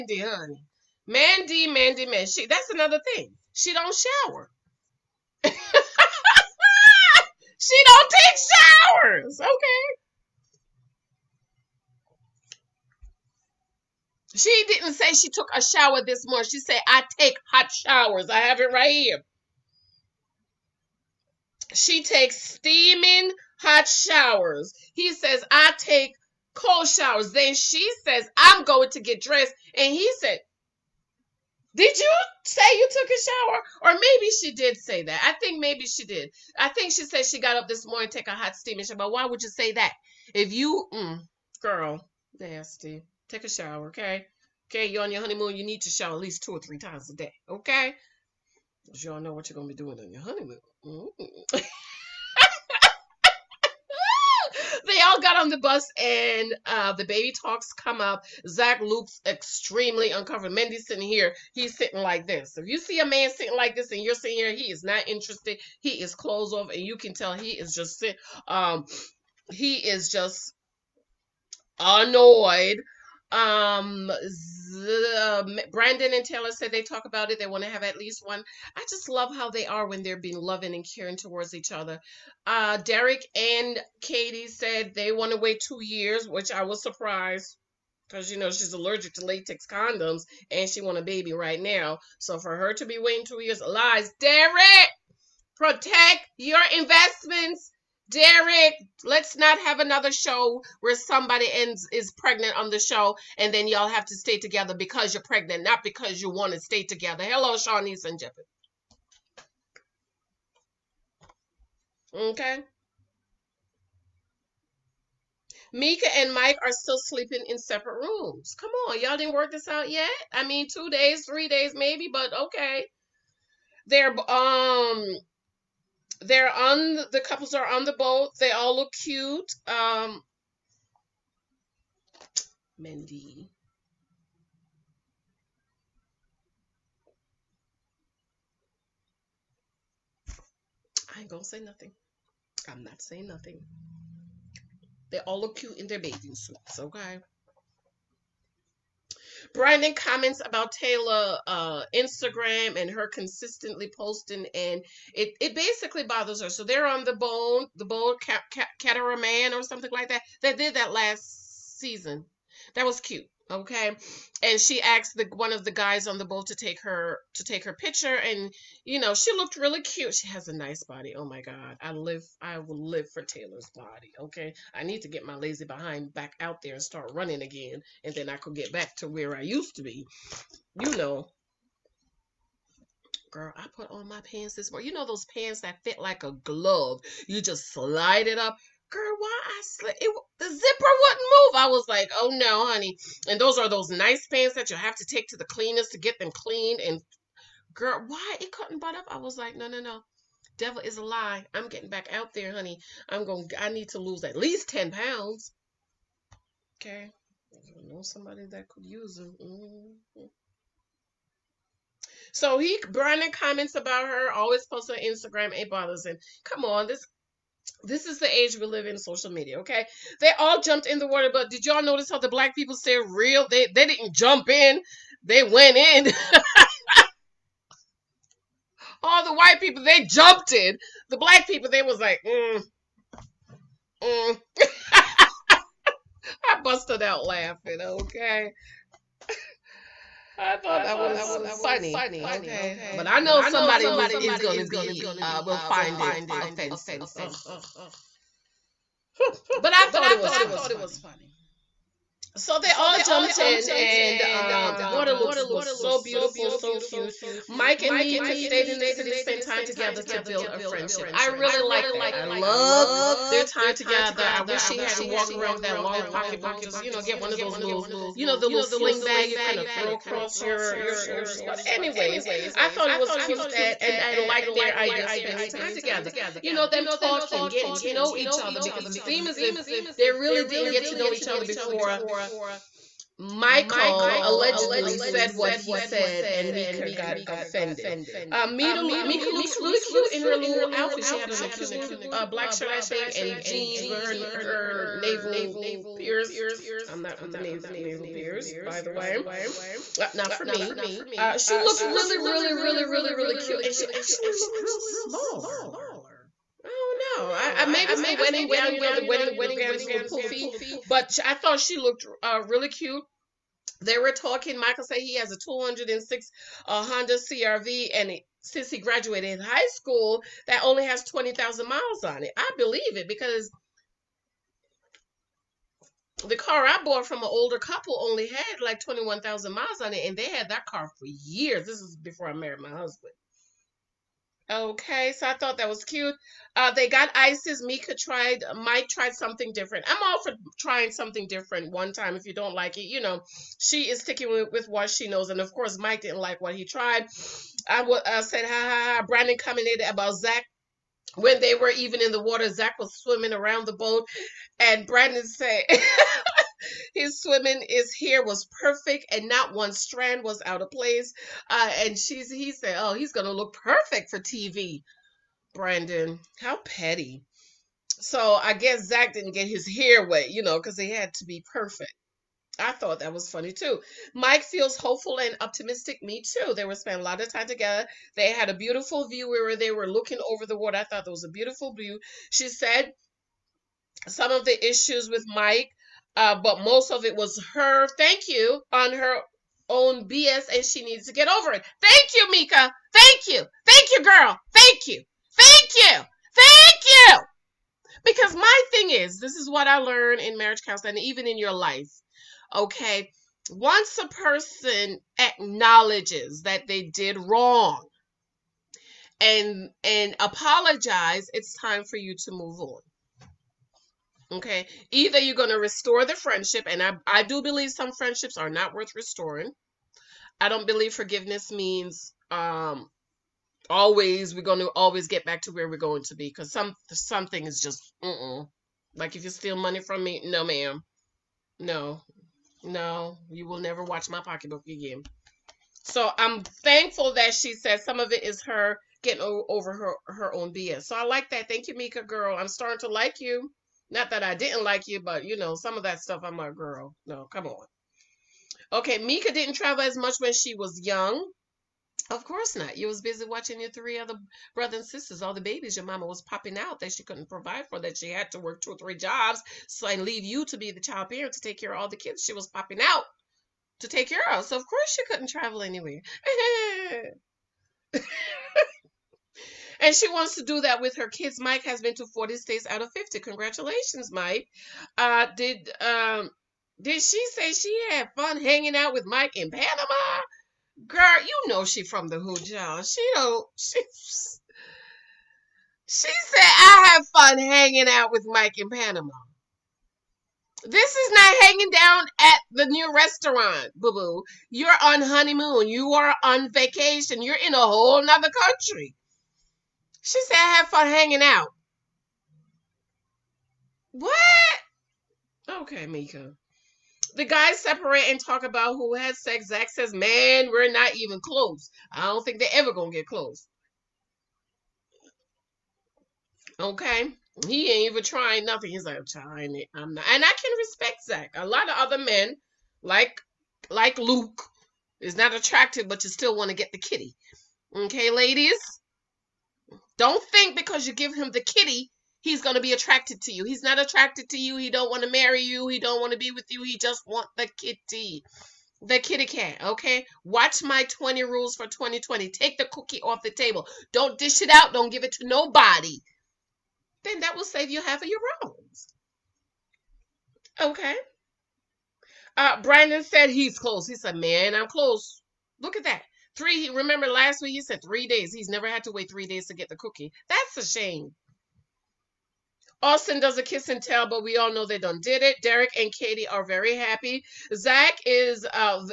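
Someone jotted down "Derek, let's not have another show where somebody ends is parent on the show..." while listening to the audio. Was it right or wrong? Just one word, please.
wrong.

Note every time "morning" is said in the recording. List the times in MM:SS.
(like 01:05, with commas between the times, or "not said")
00:16, 00:37, 03:04.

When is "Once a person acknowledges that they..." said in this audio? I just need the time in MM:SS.
06:43.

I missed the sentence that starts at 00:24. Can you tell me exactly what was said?
He says, I take cold showers.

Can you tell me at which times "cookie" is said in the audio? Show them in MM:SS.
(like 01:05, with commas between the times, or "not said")
09:02, 09:19.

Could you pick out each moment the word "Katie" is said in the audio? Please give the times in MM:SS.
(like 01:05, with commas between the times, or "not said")
01:24, 09:25.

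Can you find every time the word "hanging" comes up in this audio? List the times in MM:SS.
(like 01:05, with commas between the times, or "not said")
07:58, 08:07, 08:11, 08:20.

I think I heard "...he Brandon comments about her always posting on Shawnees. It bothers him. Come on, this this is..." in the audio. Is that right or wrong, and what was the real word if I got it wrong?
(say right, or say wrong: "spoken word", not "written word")
wrong: "Instagram", not "Shawnees".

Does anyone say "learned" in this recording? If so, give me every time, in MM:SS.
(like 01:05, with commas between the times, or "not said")
06:39.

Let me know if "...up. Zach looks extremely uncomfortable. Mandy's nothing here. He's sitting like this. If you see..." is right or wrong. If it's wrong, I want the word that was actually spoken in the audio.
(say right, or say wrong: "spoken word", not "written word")
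wrong: "sitting", not "nothing".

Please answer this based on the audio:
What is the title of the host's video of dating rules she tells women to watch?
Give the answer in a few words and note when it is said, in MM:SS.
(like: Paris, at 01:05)
20 rules for 2020, at 09:00.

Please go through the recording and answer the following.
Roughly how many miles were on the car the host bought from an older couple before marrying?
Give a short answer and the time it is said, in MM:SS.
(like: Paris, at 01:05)
21,000, at 05:28.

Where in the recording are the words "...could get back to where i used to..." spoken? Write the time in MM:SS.
02:58.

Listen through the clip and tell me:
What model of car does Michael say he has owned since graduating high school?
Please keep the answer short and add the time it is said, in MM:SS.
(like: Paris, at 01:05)
Honda CRV, at 05:16.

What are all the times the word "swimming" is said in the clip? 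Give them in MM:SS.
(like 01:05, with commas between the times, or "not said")
05:52, 05:57.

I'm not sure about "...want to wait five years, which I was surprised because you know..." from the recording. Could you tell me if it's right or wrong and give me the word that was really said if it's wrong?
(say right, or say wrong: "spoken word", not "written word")
wrong: "two", not "five".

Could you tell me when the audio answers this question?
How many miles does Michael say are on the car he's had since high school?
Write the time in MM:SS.
05:21.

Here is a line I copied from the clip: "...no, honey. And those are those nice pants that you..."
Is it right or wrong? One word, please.
right.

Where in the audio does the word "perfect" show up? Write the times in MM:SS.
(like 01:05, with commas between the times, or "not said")
05:58, 06:03, 06:11.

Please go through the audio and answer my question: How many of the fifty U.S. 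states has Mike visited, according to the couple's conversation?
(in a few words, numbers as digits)
40.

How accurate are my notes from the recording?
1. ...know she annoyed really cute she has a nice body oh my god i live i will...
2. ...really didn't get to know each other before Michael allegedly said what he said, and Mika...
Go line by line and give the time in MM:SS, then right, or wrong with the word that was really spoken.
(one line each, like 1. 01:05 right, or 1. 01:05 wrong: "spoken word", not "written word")
1. 02:48 wrong: "looked", not "annoyed"
2. 04:40 right.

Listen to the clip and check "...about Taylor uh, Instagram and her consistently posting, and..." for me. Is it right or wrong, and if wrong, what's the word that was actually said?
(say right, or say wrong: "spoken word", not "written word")
right.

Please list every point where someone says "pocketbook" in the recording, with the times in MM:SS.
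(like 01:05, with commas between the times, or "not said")
04:26, 07:14.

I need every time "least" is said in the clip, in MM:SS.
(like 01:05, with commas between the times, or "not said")
00:46, 01:17, 03:24.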